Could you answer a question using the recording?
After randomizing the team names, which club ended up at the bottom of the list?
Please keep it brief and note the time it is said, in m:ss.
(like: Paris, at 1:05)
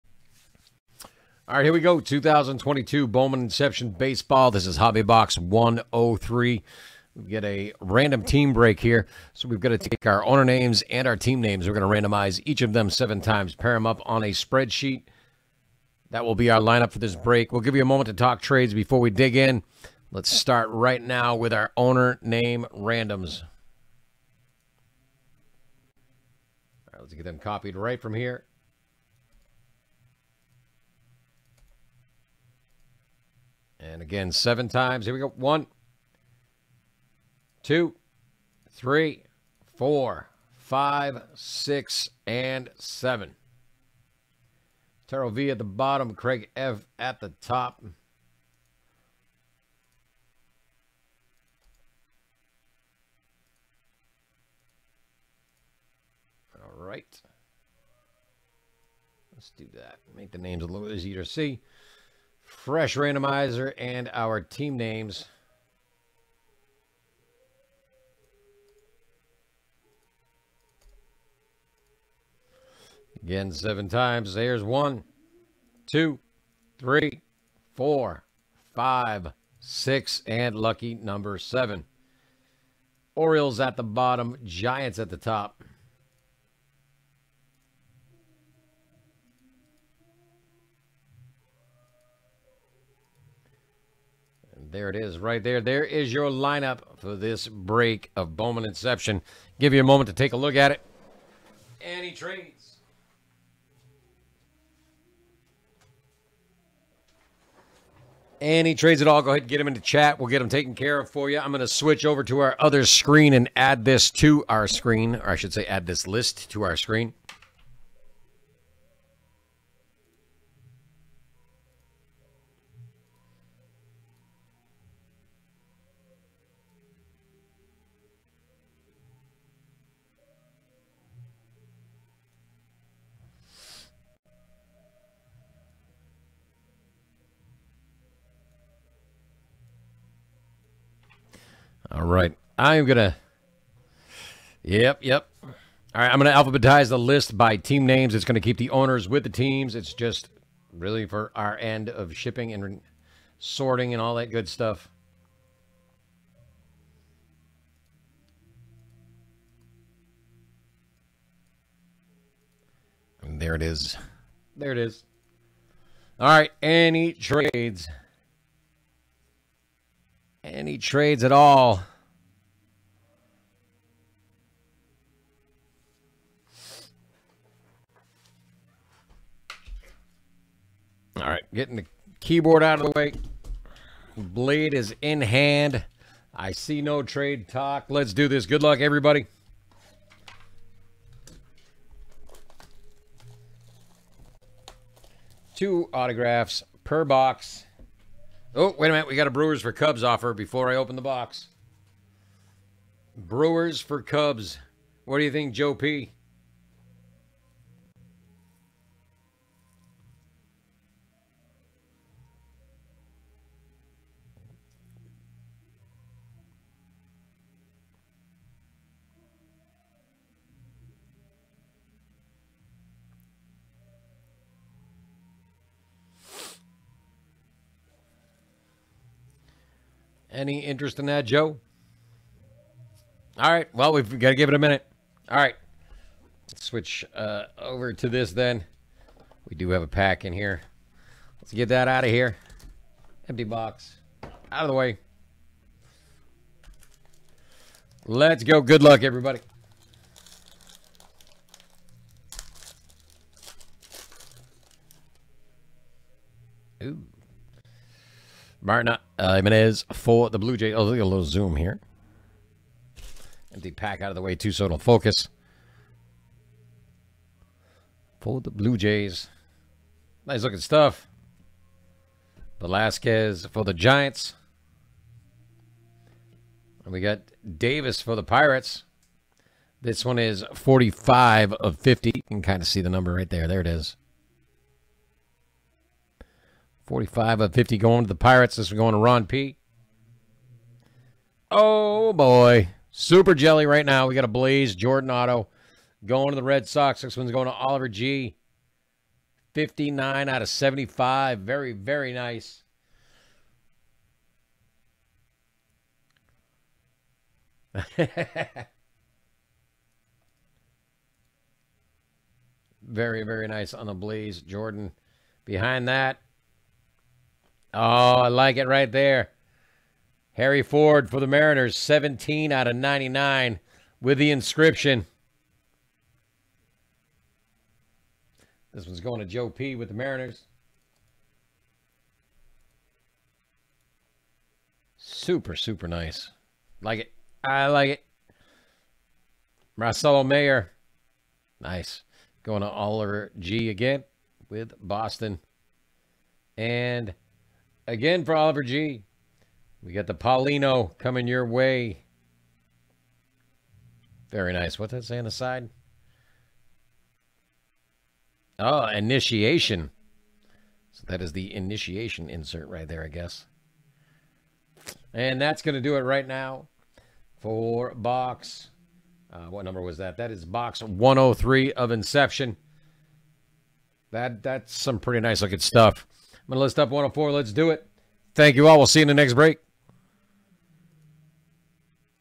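Orioles, at 1:23.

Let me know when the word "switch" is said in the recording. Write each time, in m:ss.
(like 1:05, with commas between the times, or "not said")
1:51, 3:56.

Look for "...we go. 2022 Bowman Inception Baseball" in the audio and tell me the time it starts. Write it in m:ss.
0:01.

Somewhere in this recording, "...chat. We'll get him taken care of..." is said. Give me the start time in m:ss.
1:49.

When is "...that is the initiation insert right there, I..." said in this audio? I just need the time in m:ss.
6:01.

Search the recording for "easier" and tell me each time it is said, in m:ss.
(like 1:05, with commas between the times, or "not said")
1:00.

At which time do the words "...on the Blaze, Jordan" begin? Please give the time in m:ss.
5:13.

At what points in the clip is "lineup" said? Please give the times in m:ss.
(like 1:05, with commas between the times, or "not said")
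0:16, 1:36.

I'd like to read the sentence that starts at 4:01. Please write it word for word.
Let's get that out of here.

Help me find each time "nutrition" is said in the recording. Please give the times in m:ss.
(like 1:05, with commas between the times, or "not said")
not said.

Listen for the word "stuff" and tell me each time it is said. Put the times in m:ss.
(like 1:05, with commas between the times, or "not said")
2:34, 4:30, 6:15.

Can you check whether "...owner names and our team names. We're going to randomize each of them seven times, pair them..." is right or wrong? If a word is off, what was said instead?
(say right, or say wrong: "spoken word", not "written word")
right.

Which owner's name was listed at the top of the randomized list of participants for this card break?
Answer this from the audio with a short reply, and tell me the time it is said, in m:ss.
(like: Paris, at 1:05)
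Craig F, at 0:46.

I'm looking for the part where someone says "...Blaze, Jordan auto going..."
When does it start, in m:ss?
4:54.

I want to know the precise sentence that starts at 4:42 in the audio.
You can kind of see the number right there.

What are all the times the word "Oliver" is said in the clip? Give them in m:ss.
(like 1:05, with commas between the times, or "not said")
4:57, 5:42, 5:48.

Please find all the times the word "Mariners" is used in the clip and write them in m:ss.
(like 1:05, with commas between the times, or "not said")
5:21, 5:29.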